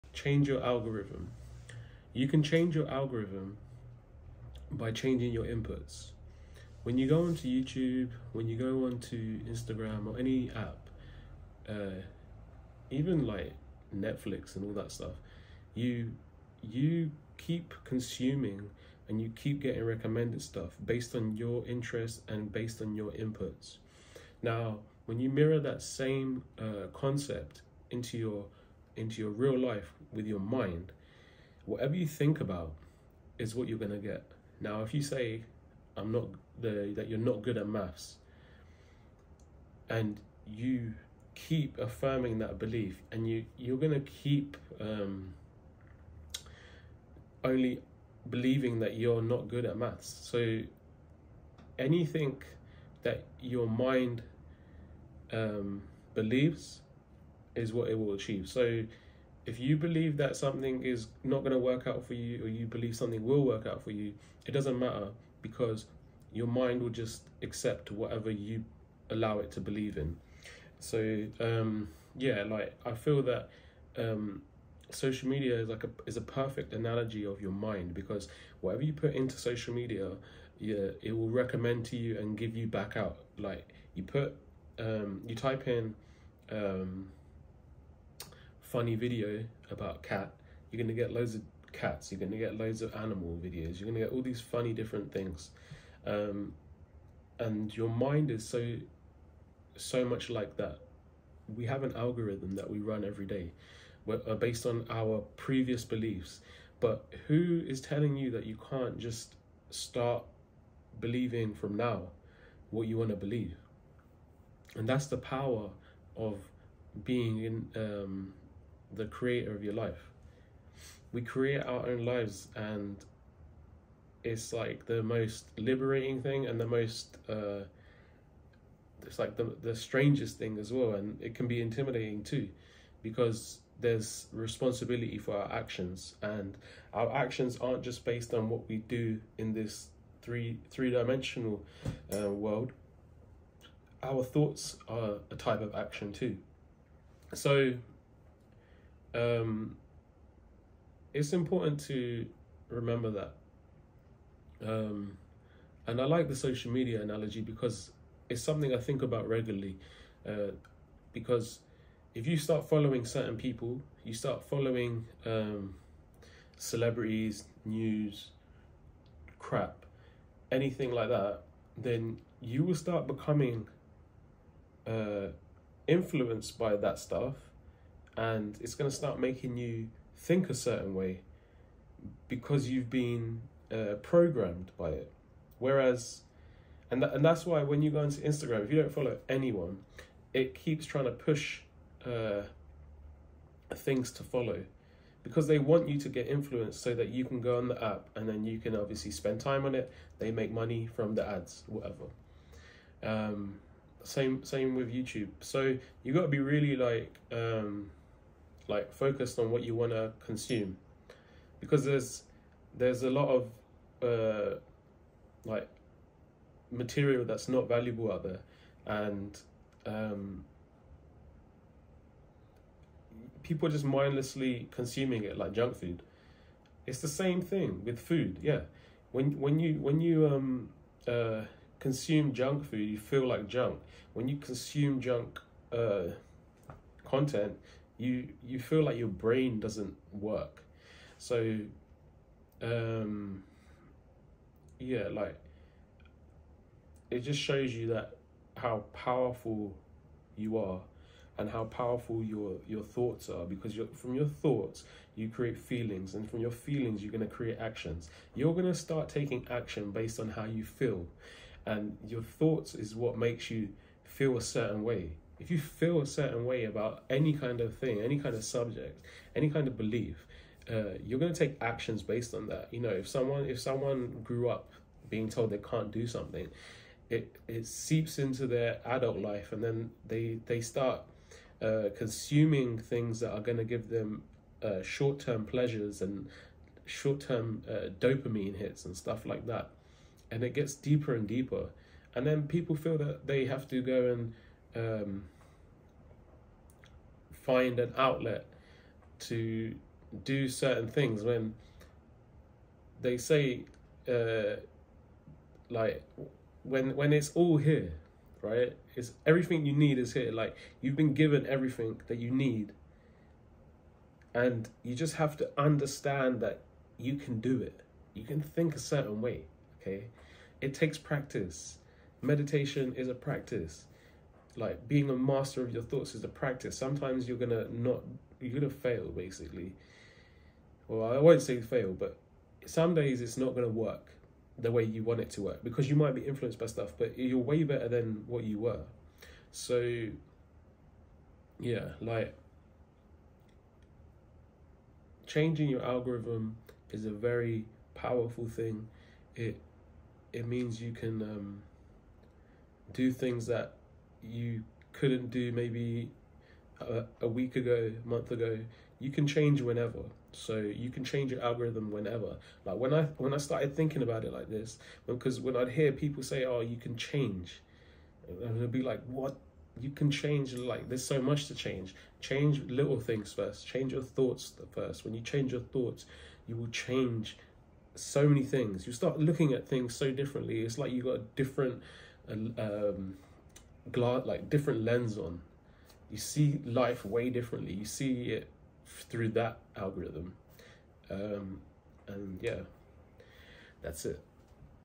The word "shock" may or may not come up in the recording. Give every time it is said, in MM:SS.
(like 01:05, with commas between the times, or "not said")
not said.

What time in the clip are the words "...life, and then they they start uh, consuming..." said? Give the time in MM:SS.
04:39.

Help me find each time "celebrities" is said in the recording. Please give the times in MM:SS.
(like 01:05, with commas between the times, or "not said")
02:46.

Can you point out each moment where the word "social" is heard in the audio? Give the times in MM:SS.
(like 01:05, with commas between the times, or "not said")
01:14, 01:19, 02:36.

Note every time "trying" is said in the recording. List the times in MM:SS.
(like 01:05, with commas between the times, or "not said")
03:10.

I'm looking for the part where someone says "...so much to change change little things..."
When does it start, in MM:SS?
06:11.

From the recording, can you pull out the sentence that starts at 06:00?
So you can change your algorithm whenever.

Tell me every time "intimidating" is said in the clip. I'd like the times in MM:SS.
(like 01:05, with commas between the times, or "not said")
02:11.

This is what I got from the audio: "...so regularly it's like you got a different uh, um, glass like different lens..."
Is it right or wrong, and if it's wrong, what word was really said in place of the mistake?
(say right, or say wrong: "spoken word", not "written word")
wrong: "differently", not "regularly".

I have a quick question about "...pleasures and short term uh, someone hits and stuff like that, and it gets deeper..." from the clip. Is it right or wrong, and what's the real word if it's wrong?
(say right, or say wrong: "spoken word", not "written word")
wrong: "dopamine", not "someone".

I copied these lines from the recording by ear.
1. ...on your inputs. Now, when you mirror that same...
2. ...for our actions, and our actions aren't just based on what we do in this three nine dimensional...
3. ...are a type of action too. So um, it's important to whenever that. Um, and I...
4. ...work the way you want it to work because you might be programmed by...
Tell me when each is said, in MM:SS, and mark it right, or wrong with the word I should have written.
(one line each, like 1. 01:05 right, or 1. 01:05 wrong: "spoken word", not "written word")
1. 00:22 right
2. 02:15 wrong: "three", not "nine"
3. 02:24 wrong: "remember", not "whenever"
4. 05:33 wrong: "influenced", not "programmed".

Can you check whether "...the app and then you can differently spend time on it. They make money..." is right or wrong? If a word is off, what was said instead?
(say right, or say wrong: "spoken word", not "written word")
wrong: "obviously", not "differently".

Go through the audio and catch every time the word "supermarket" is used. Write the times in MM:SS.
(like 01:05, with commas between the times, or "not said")
not said.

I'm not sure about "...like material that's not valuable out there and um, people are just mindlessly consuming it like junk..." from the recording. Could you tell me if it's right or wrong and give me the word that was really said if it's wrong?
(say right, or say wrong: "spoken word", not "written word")
right.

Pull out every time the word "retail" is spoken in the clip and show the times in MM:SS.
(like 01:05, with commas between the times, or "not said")
not said.